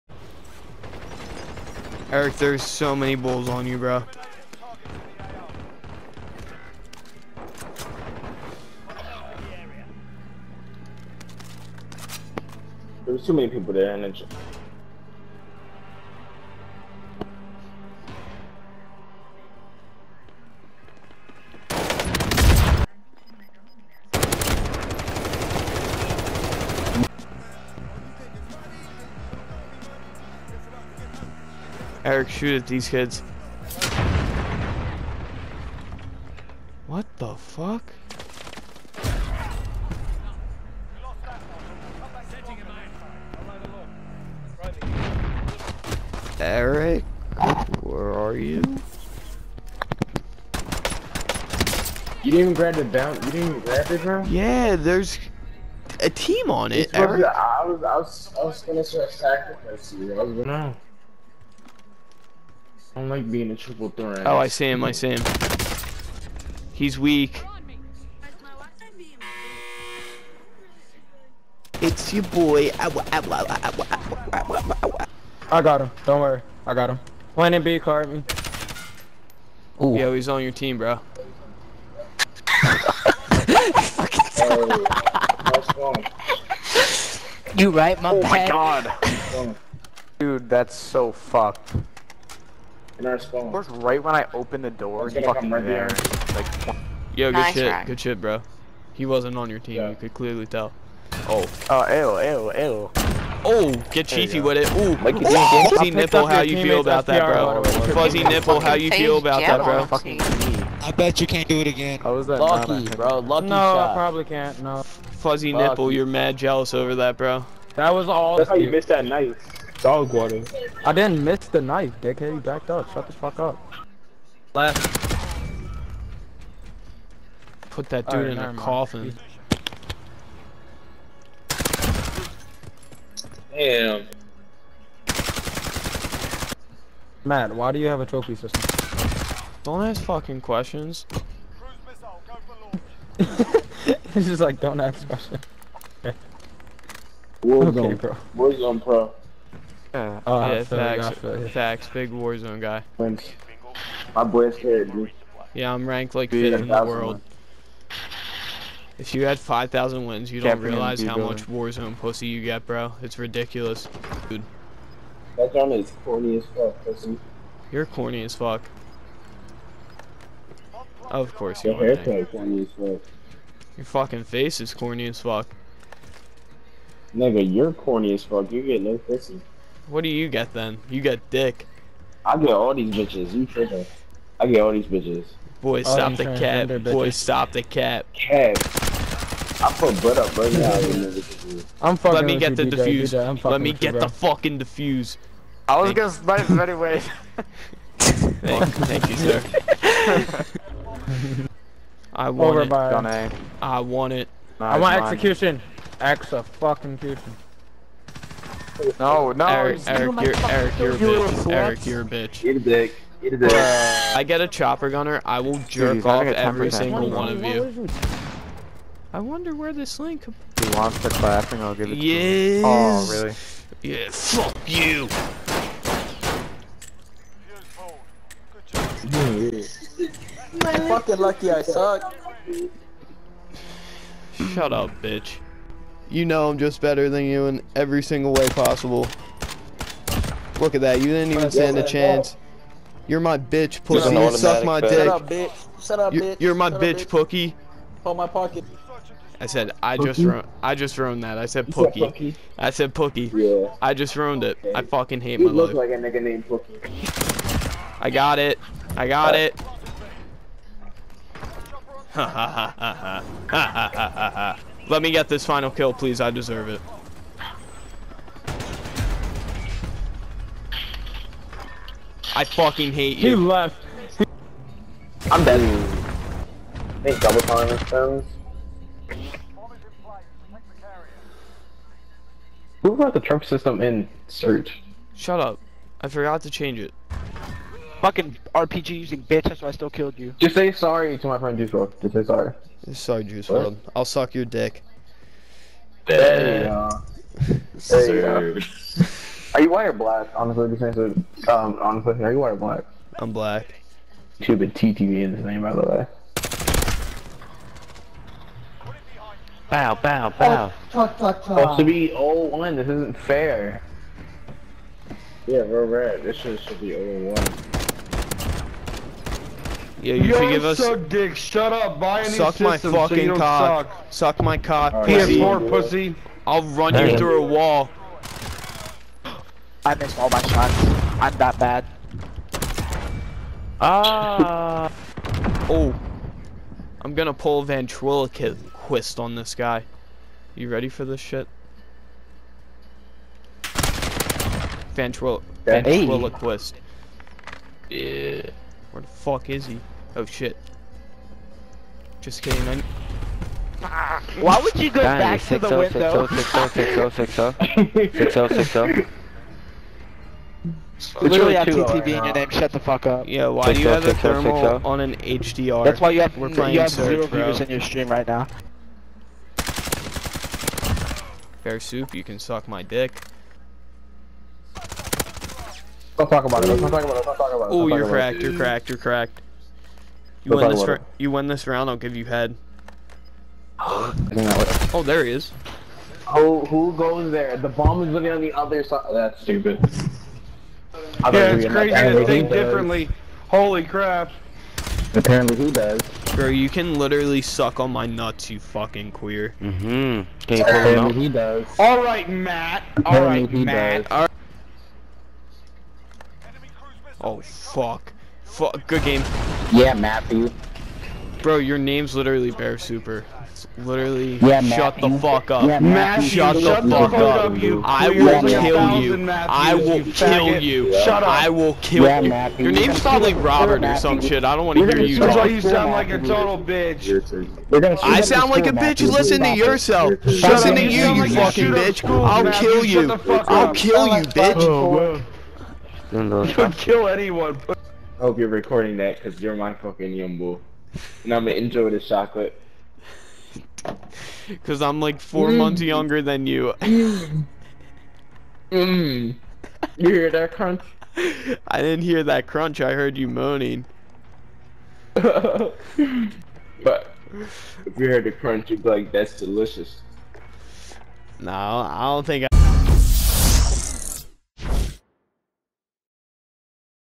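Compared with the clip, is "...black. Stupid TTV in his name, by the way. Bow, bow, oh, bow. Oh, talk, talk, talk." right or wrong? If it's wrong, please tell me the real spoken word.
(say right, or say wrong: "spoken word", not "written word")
right.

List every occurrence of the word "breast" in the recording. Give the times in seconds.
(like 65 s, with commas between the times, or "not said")
not said.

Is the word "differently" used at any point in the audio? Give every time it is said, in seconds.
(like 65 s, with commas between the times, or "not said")
392 s.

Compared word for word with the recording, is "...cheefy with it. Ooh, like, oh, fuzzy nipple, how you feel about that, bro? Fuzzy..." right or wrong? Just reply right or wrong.
right.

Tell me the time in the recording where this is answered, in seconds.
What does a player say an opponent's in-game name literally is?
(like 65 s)
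412 s.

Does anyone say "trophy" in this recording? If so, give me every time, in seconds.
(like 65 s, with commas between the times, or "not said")
138 s, 283 s.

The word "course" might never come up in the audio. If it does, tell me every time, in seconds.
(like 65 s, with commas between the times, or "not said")
93 s, 171 s.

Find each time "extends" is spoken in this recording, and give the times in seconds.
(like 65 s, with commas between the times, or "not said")
277 s.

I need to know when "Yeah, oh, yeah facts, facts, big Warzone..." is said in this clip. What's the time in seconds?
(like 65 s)
149 s.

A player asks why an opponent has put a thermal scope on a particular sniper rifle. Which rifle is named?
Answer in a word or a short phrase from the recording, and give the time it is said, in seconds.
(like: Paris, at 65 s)
HDR, at 365 s.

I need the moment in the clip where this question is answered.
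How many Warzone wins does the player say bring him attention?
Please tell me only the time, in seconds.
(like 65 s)
159 s.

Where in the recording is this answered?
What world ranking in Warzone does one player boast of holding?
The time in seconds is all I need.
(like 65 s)
156 s.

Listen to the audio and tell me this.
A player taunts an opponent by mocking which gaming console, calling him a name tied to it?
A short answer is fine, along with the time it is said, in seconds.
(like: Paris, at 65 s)
PS4, at 325 s.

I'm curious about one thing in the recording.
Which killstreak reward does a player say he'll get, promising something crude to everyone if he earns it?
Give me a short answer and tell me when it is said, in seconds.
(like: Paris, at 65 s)
Chopper gunner, at 214 s.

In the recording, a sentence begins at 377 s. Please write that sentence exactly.
Oh, you're cracked, you're cracked, you're cracked.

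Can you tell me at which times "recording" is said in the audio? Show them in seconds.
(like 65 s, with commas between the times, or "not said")
438 s.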